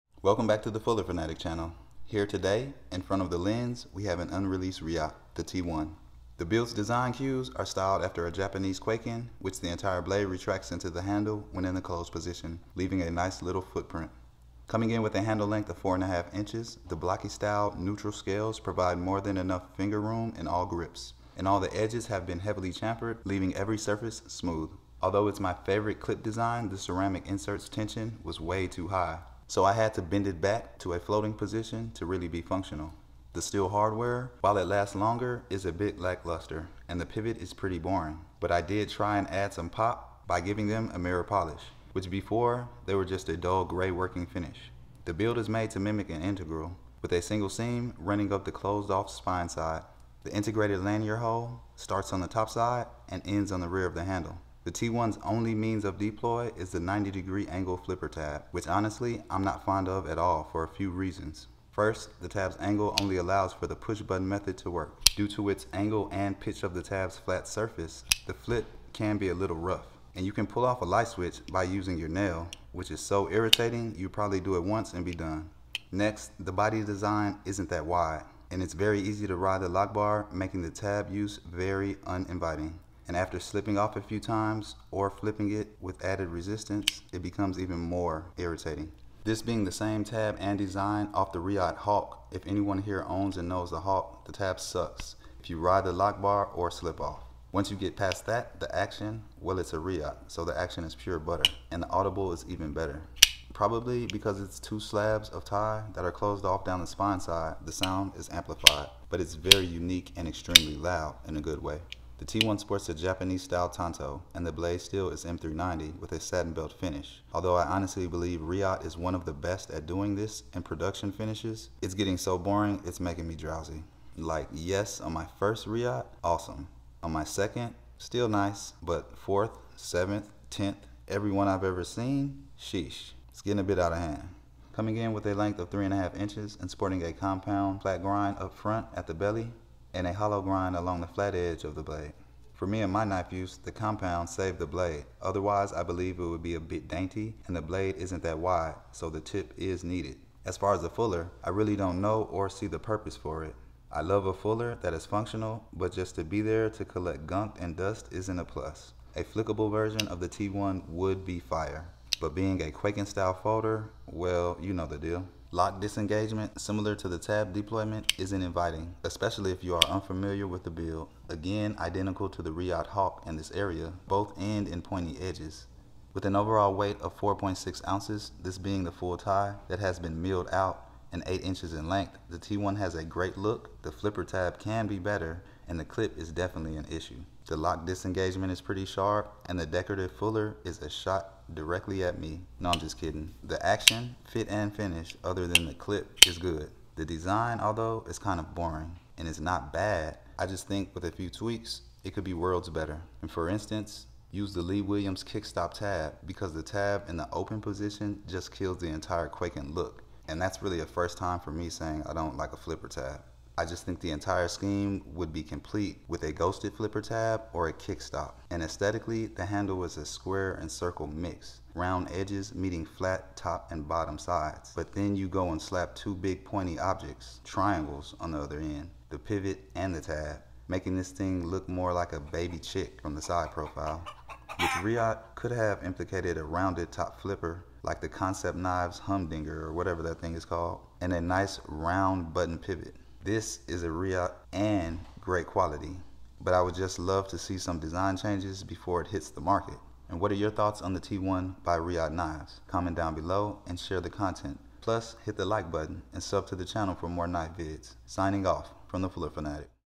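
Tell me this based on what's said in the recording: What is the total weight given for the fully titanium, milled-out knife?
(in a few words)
4.6 ounces.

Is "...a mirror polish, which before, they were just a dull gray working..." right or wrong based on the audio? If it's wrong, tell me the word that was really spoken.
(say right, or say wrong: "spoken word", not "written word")
right.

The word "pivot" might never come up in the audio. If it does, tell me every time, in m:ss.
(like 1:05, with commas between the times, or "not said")
0:37, 3:49, 4:02.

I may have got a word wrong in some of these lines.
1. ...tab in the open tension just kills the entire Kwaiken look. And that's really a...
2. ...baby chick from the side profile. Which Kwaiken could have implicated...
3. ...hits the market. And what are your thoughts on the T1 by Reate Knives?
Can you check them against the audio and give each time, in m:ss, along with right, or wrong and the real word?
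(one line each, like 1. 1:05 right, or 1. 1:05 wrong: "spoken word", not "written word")
1. 3:26 wrong: "position", not "tension"
2. 3:52 wrong: "Reate", not "Kwaiken"
3. 4:09 right.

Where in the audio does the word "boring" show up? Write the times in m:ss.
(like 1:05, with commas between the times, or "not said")
0:37, 2:02, 3:18.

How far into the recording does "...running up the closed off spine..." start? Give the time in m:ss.
0:47.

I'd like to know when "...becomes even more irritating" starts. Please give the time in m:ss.
1:27.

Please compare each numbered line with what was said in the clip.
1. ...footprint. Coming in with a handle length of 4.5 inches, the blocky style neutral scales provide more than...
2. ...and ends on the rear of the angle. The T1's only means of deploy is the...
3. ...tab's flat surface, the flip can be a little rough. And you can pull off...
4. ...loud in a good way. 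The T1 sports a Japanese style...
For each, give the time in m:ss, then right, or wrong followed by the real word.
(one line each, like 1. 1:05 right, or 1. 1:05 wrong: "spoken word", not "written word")
1. 0:13 right
2. 0:53 wrong: "handle", not "angle"
3. 1:06 right
4. 1:50 right.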